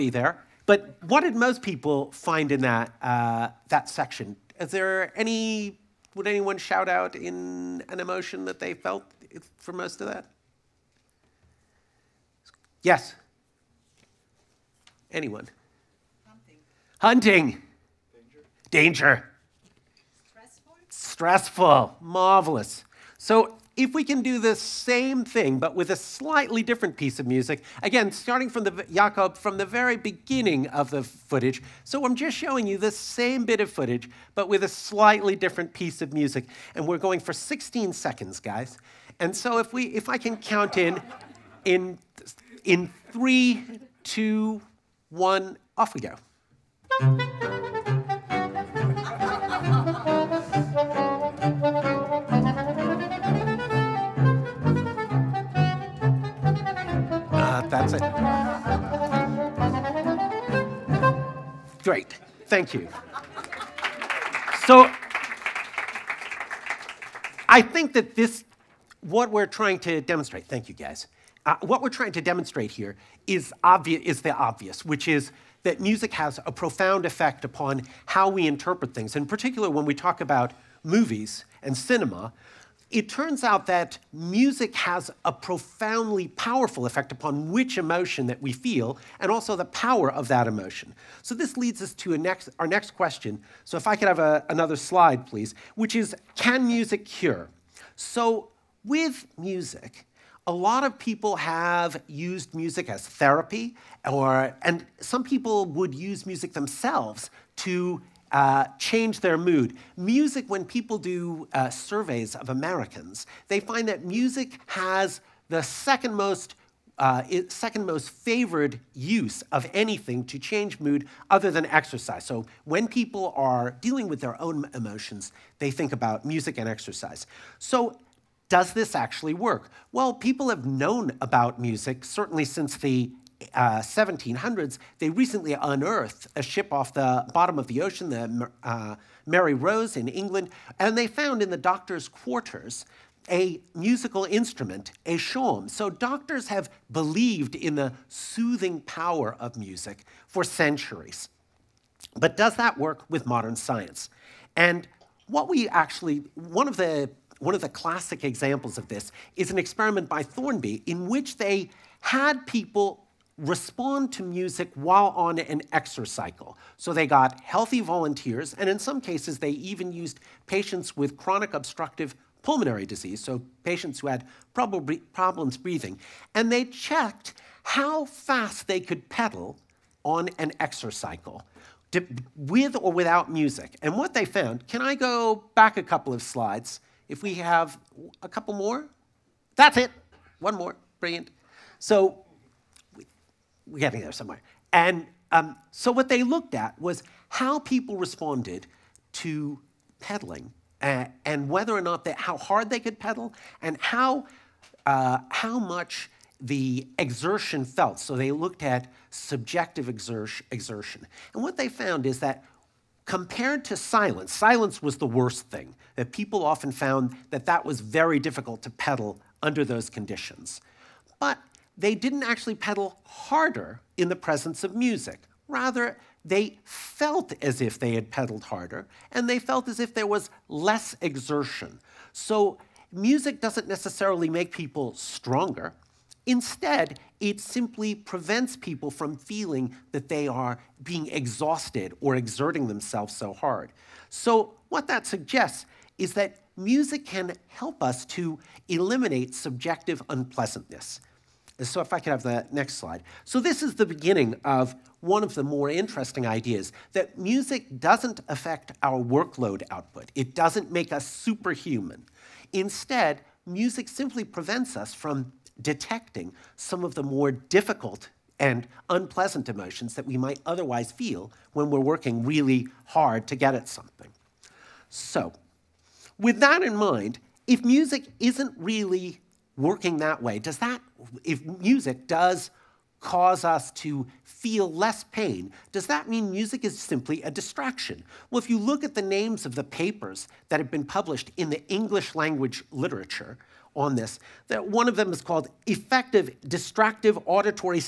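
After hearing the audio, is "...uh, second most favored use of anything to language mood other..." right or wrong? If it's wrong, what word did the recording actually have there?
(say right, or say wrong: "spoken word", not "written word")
wrong: "change", not "language".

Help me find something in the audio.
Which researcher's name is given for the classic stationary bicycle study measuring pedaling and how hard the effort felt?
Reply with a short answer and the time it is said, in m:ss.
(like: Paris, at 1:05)
Thornby, at 2:40.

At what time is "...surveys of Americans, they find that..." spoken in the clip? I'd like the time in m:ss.
1:51.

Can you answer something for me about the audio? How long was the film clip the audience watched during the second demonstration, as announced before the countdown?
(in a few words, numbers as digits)
16 seconds.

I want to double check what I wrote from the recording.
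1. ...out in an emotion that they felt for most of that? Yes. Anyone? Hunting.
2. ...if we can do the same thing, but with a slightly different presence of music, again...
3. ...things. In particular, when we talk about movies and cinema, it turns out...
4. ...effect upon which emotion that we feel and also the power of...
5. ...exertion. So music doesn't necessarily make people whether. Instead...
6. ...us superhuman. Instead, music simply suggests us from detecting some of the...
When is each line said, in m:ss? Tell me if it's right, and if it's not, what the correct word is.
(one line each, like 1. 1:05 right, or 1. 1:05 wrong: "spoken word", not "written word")
1. 0:06 right
2. 0:23 wrong: "piece", not "presence"
3. 1:18 right
4. 1:26 right
5. 3:51 wrong: "stronger", not "whether"
6. 4:20 wrong: "prevents", not "suggests".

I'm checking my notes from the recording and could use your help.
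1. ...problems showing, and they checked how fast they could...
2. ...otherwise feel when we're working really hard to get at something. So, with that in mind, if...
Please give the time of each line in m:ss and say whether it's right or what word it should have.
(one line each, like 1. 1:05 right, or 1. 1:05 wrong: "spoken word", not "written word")
1. 2:54 wrong: "breathing", not "showing"
2. 4:30 right.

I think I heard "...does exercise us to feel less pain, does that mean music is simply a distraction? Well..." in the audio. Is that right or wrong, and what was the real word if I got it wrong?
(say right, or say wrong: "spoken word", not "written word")
wrong: "cause", not "exercise".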